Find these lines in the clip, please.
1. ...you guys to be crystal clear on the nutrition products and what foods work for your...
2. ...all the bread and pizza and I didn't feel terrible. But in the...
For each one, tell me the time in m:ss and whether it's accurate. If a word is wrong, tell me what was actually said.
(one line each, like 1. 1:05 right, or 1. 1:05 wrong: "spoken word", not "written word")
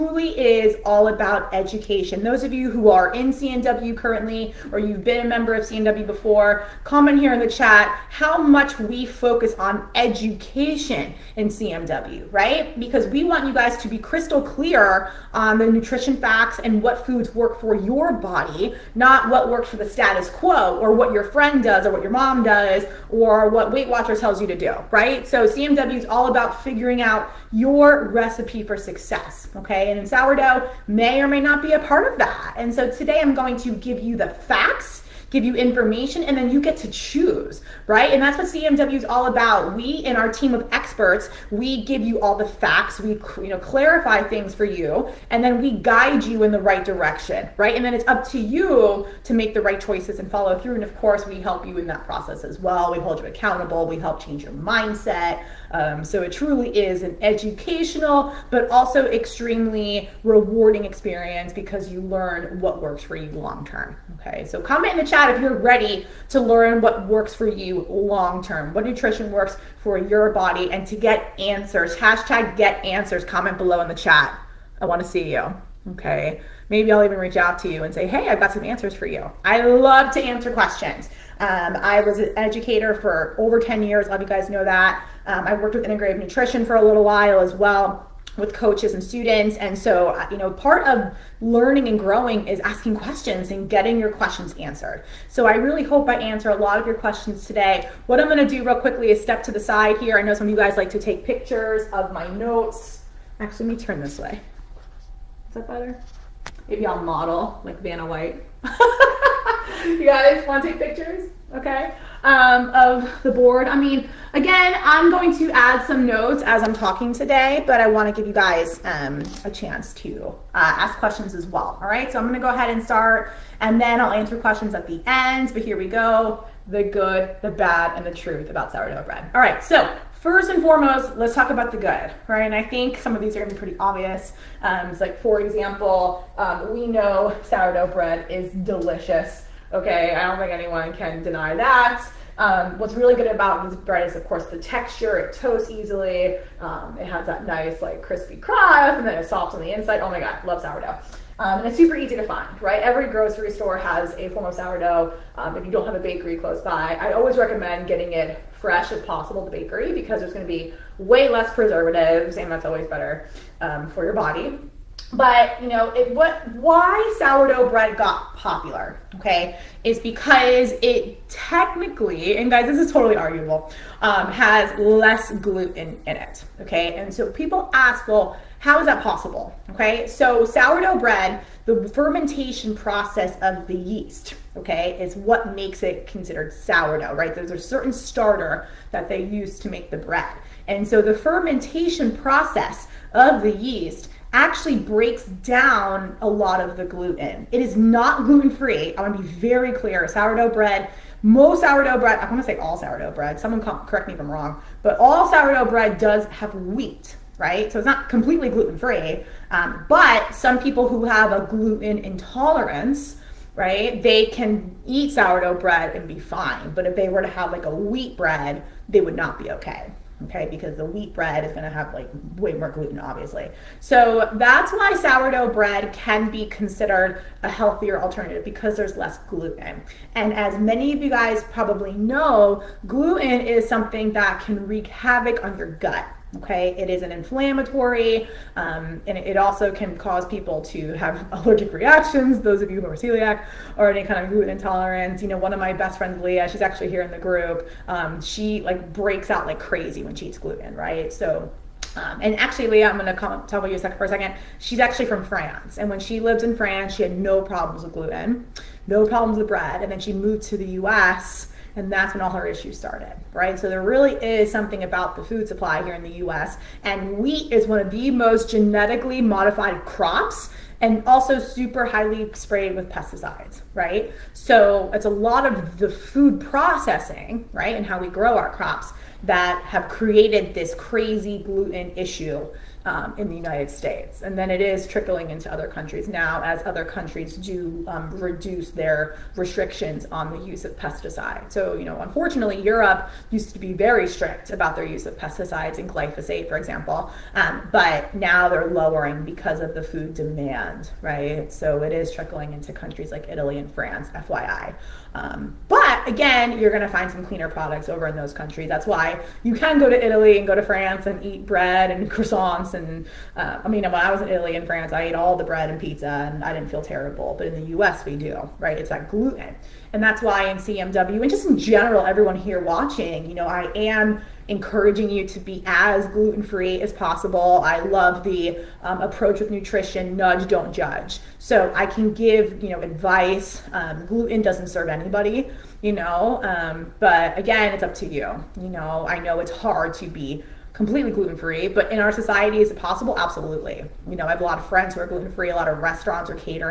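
1. 0:13 wrong: "facts", not "products"
2. 5:15 right.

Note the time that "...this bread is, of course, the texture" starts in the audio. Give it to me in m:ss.
2:23.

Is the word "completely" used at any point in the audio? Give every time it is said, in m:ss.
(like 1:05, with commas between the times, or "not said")
3:28, 5:40.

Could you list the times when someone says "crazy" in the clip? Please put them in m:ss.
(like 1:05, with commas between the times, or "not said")
4:09, 4:40.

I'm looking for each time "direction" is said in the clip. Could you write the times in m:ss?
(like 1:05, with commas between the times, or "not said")
0:46.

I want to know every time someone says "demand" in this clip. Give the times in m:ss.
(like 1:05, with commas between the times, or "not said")
5:00.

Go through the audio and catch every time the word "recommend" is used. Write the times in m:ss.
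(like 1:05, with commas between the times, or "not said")
2:37.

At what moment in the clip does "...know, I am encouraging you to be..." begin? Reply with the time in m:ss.
5:23.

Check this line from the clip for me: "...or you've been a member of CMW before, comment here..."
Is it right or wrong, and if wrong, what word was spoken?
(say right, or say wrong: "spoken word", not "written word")
right.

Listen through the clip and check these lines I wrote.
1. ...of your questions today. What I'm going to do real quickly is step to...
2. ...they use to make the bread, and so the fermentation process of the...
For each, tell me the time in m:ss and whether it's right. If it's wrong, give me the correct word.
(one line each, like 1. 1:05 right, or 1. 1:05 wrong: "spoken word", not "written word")
1. 1:36 right
2. 3:09 right.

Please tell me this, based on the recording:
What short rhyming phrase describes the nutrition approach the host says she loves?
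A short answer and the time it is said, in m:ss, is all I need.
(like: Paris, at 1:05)
nudge, don't judge, at 5:30.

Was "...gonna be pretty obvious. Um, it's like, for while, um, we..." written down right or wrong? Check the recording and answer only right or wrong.
wrong.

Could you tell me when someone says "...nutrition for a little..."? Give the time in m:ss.
1:26.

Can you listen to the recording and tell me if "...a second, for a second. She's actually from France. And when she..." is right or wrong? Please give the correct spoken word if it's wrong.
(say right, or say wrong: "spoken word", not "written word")
right.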